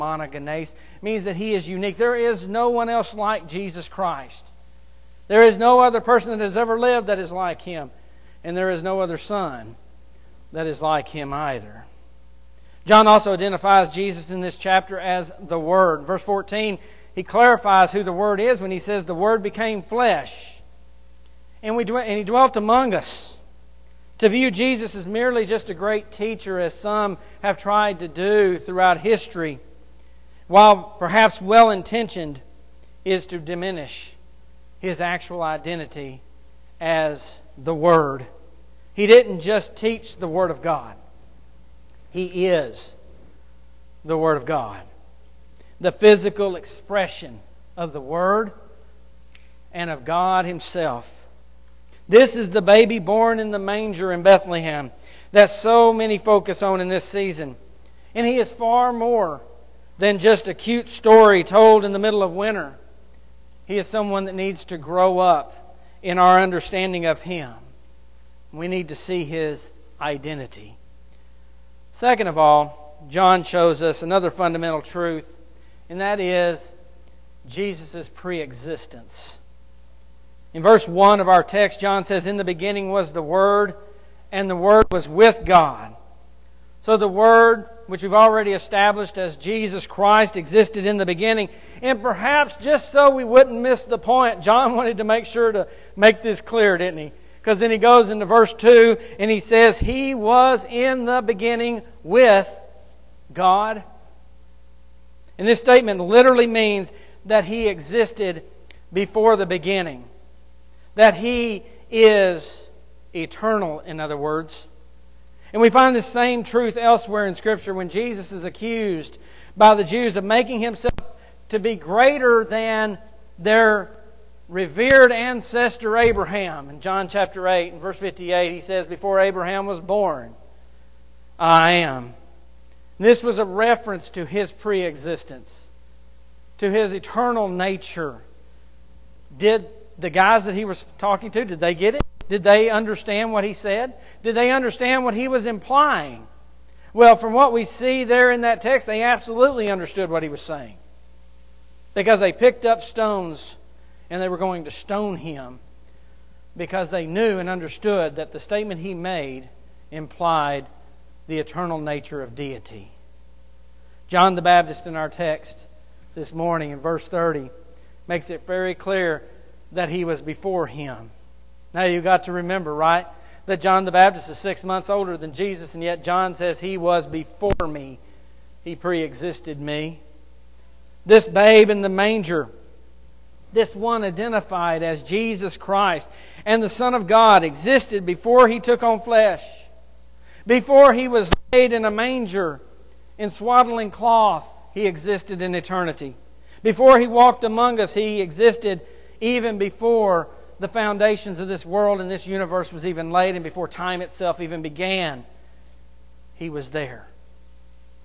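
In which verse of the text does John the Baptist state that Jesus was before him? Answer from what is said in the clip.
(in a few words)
30.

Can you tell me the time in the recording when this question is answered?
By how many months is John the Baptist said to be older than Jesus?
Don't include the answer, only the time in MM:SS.
02:54.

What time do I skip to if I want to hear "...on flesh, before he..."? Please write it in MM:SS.
03:08.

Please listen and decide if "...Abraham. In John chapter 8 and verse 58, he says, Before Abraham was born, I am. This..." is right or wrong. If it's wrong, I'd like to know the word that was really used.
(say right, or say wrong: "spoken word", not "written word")
right.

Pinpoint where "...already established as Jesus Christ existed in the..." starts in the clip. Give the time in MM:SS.
01:28.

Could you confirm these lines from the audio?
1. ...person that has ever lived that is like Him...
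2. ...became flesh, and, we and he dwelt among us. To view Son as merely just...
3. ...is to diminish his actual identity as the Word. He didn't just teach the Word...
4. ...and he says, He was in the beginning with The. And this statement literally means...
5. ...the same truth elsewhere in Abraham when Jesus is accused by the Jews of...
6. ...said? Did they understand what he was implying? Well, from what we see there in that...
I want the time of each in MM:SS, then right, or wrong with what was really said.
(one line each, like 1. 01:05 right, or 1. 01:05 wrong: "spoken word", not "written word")
1. 00:06 right
2. 00:19 wrong: "Jesus", not "Son"
3. 00:33 right
4. 01:39 wrong: "God", not "The"
5. 01:55 wrong: "Scripture", not "Abraham"
6. 02:23 right.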